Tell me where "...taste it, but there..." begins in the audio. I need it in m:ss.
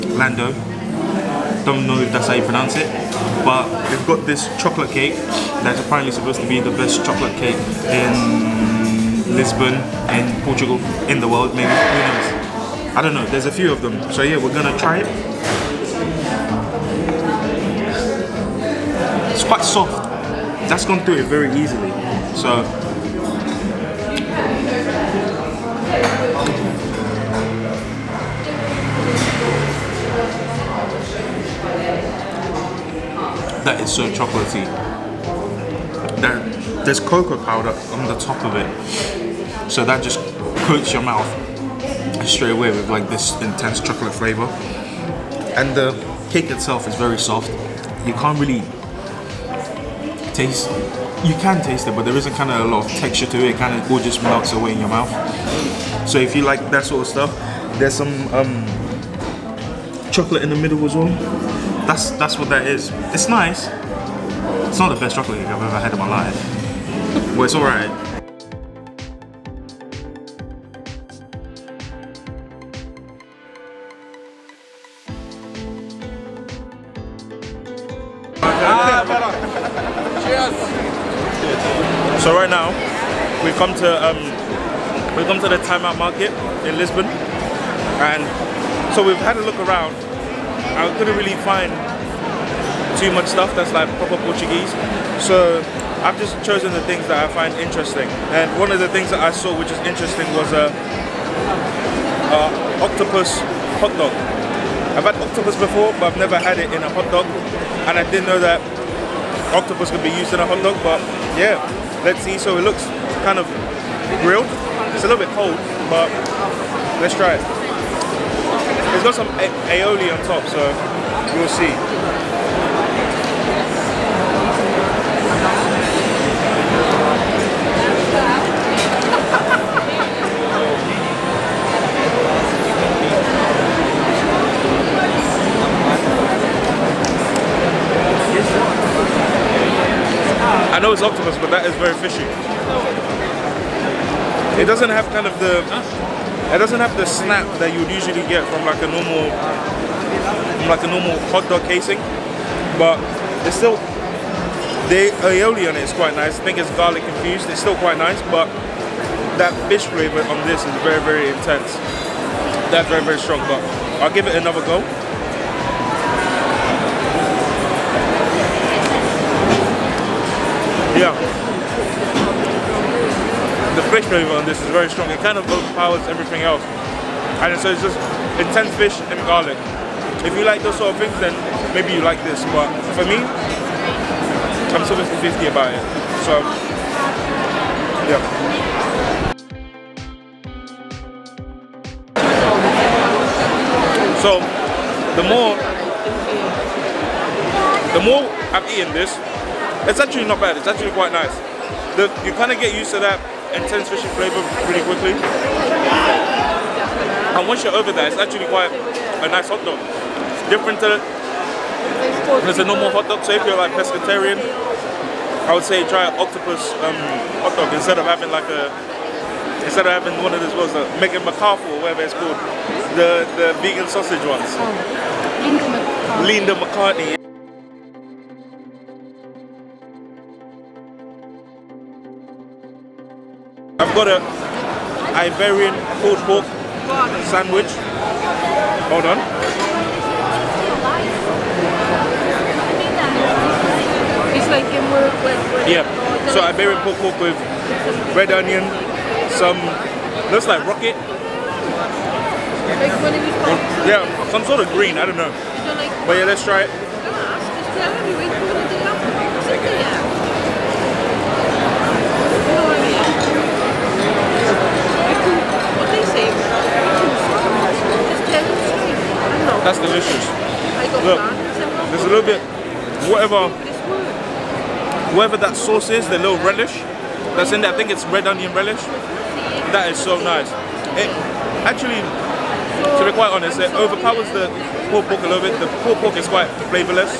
0:51.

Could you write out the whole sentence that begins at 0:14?
So yeah, we're gonna try it.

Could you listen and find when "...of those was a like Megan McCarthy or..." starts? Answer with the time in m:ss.
3:40.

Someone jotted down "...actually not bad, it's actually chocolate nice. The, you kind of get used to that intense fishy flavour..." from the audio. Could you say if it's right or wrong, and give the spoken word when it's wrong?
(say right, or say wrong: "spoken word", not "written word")
wrong: "quite", not "chocolate".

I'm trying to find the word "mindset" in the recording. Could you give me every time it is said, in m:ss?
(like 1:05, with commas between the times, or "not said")
not said.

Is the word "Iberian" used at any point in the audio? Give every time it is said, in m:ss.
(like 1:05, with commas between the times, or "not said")
3:55, 4:06.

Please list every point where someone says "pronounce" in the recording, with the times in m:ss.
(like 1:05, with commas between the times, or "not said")
0:02.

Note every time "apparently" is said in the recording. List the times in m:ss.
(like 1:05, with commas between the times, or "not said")
0:05.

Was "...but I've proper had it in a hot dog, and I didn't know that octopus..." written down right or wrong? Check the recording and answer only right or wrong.
wrong.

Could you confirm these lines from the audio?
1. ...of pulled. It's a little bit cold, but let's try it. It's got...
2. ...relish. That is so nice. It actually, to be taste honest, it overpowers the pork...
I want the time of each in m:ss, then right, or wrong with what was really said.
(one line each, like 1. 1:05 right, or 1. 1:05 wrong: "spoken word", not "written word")
1. 1:53 wrong: "grilled", not "pulled"
2. 4:38 wrong: "quite", not "taste".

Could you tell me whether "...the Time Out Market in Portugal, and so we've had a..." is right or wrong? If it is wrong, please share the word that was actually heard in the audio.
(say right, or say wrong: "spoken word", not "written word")
wrong: "Lisbon", not "Portugal".